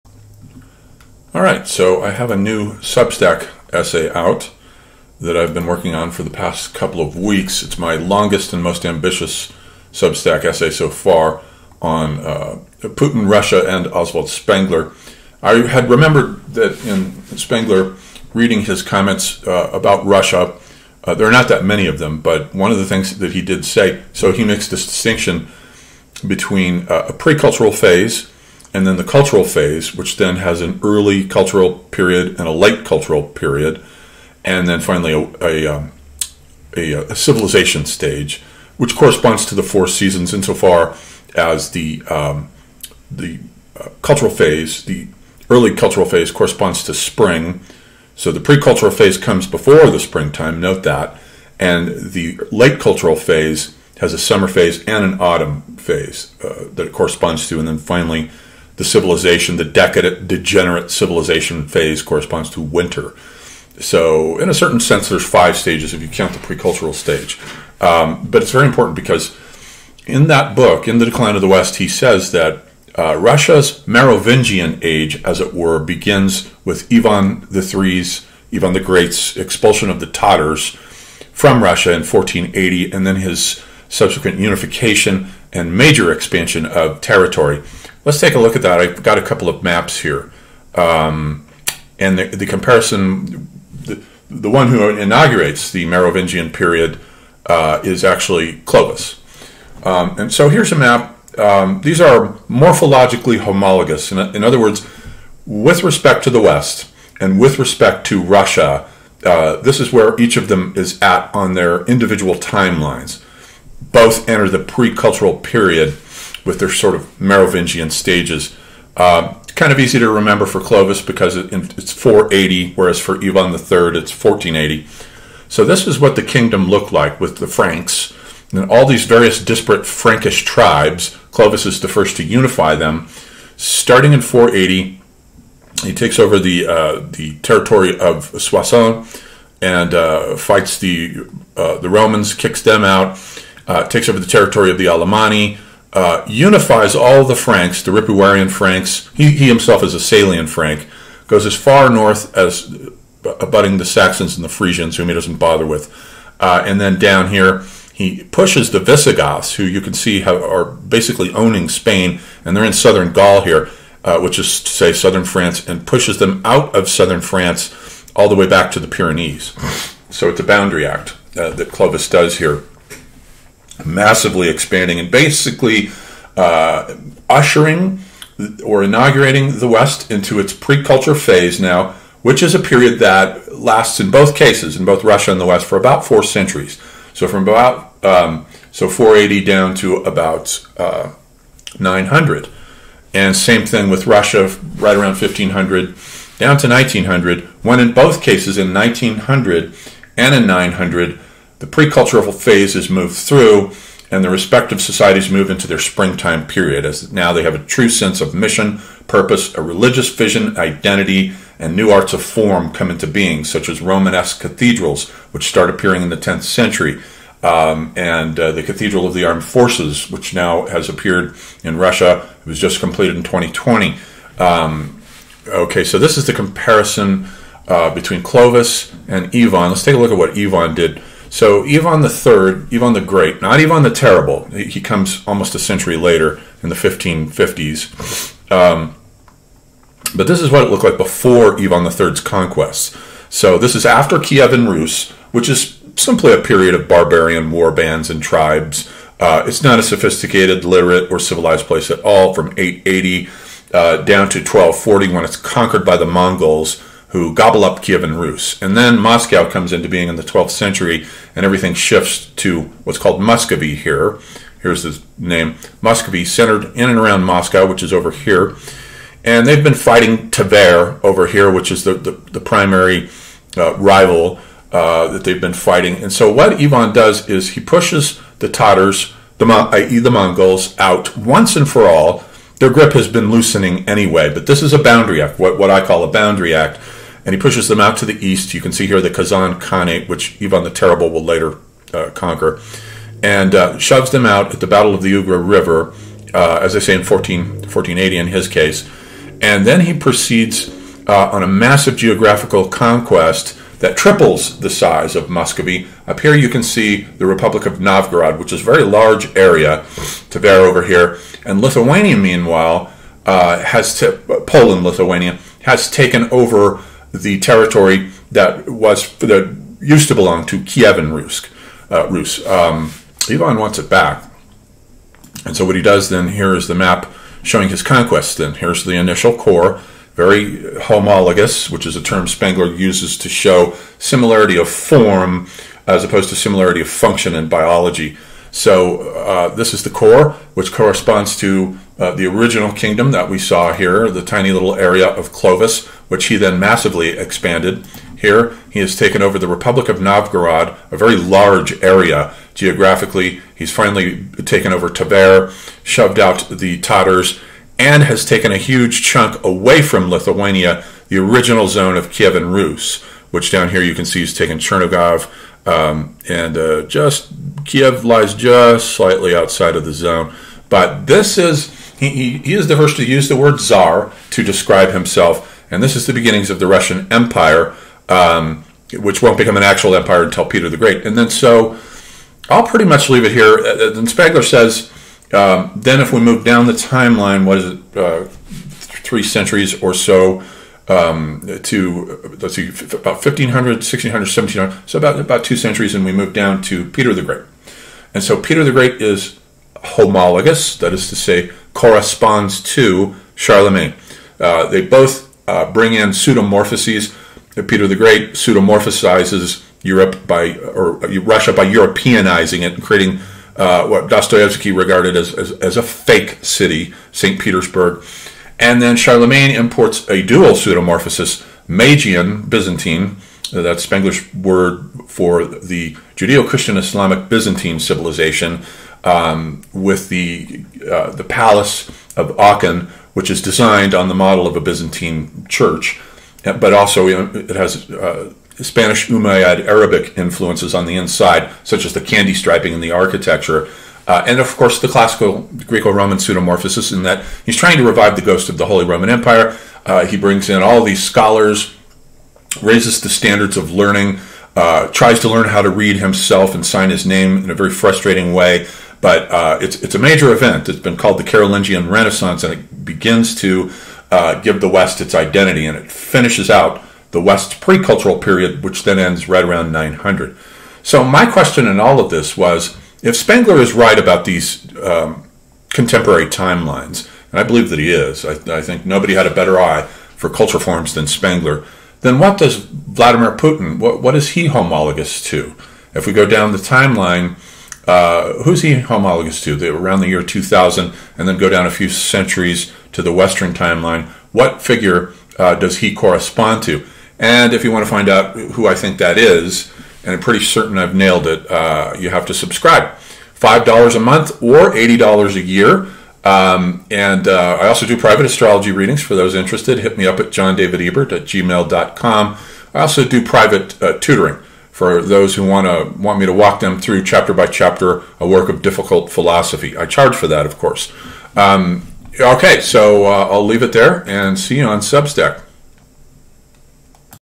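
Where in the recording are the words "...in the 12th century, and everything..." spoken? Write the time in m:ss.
4:20.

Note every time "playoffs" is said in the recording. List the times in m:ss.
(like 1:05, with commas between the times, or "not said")
not said.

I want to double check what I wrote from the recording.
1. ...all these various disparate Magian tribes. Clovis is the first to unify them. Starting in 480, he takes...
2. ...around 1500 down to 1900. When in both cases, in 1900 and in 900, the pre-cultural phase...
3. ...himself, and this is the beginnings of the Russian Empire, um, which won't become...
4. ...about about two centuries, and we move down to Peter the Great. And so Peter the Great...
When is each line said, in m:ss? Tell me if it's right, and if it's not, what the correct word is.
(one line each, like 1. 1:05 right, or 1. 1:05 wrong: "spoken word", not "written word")
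1. 2:08 wrong: "Frankish", not "Magian"
2. 3:14 right
3. 6:14 right
4. 6:34 right.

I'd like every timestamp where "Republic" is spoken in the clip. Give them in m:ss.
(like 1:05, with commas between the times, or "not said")
5:07, 5:49.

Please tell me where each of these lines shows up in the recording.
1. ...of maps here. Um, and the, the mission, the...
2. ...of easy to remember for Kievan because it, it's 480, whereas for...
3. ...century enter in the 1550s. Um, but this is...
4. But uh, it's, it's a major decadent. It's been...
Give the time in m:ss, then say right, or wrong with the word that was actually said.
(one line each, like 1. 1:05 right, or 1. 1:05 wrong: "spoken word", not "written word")
1. 1:29 wrong: "comparison", not "mission"
2. 1:59 wrong: "Clovis", not "Kievan"
3. 3:55 wrong: "later", not "enter"
4. 7:39 wrong: "event", not "decadent".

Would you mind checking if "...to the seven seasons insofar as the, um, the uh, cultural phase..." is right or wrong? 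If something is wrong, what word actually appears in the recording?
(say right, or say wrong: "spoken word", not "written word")
wrong: "four", not "seven".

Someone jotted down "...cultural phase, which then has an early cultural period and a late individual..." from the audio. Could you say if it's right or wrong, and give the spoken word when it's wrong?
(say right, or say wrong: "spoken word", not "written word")
wrong: "cultural", not "individual".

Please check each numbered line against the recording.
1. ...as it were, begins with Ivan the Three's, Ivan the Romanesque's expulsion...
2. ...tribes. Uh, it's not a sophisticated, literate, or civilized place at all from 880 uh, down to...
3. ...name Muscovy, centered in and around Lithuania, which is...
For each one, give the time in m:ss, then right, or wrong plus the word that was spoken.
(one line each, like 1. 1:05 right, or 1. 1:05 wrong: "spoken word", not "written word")
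1. 1:15 wrong: "Great", not "Romanesque"
2. 4:08 right
3. 4:25 wrong: "Moscow", not "Lithuania".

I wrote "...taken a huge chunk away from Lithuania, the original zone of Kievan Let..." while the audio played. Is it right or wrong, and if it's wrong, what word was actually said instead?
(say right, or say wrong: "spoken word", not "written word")
wrong: "Rus", not "Let".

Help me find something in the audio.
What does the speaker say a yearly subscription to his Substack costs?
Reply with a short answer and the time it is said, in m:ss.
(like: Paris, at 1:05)
$80, at 8:24.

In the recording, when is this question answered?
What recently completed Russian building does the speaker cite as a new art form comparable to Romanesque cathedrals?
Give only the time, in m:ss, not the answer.
3:38.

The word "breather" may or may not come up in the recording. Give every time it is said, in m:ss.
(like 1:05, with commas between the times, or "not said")
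not said.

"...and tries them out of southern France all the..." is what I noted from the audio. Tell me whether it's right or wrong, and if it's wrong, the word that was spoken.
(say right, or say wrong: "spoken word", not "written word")
wrong: "pushes", not "tries".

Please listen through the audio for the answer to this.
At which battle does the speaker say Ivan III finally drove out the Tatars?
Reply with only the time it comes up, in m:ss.
4:54.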